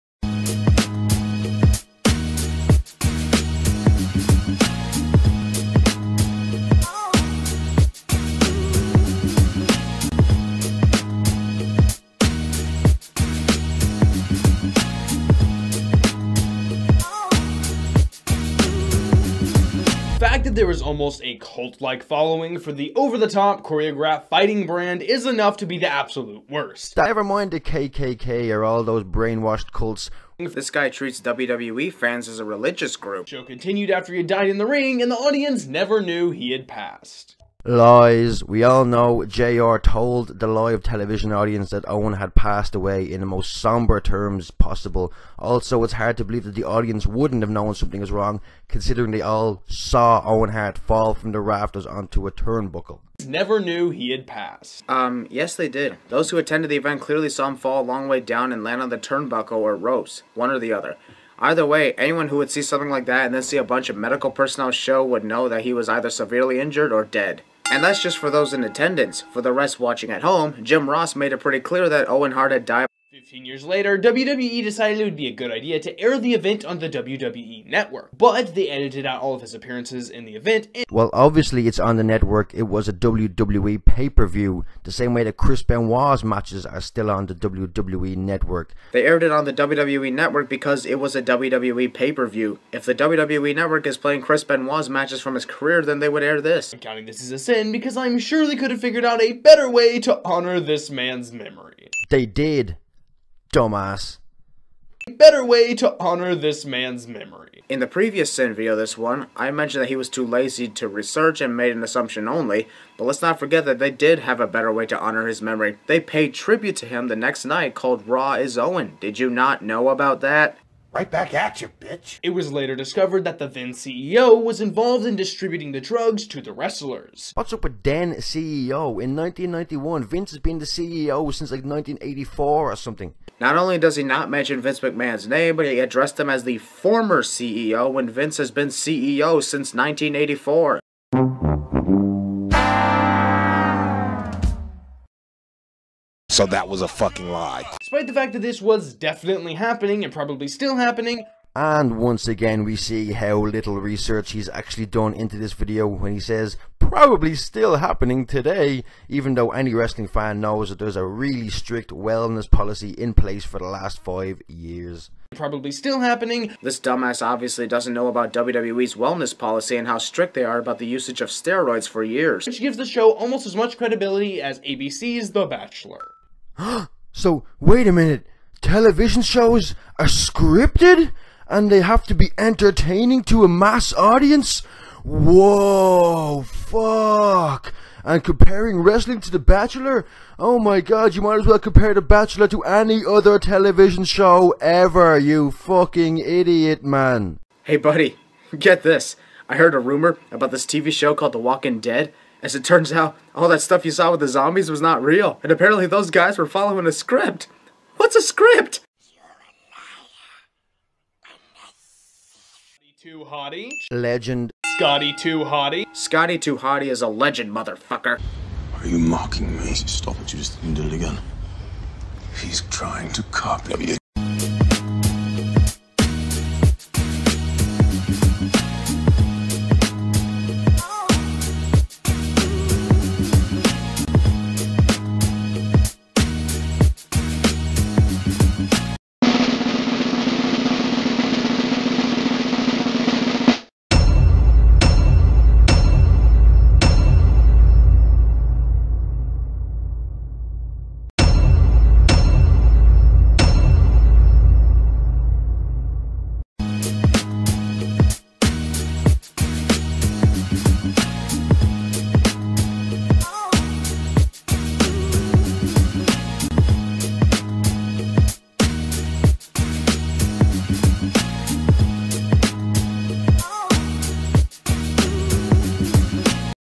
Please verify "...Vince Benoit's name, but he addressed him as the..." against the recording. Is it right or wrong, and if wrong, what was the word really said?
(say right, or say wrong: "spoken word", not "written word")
wrong: "McMahon", not "Benoit".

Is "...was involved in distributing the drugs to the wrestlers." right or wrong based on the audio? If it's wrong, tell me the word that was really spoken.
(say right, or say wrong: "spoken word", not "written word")
right.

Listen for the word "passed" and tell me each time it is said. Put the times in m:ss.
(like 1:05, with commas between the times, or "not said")
0:36, 0:42, 0:54.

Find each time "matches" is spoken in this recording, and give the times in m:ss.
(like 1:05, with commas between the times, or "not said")
1:26, 1:34.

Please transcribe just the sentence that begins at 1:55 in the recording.
They paid tribute to him the next night called Raw is Owen.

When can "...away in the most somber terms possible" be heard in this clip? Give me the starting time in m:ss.
0:42.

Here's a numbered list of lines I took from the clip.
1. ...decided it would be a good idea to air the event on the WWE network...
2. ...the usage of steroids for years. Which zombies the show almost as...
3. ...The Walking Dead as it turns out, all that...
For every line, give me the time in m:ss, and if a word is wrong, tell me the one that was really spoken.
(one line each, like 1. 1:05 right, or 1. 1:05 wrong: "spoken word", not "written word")
1. 1:14 right
2. 2:50 wrong: "gives", not "zombies"
3. 3:21 right.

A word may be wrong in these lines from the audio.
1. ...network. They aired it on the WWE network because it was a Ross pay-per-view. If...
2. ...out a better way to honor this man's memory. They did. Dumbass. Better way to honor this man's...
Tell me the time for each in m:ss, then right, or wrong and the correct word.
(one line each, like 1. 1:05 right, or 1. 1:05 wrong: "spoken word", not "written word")
1. 1:28 wrong: "WWE", not "Ross"
2. 1:39 right.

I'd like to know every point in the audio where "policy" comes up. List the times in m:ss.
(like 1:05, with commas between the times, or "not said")
2:42, 2:49.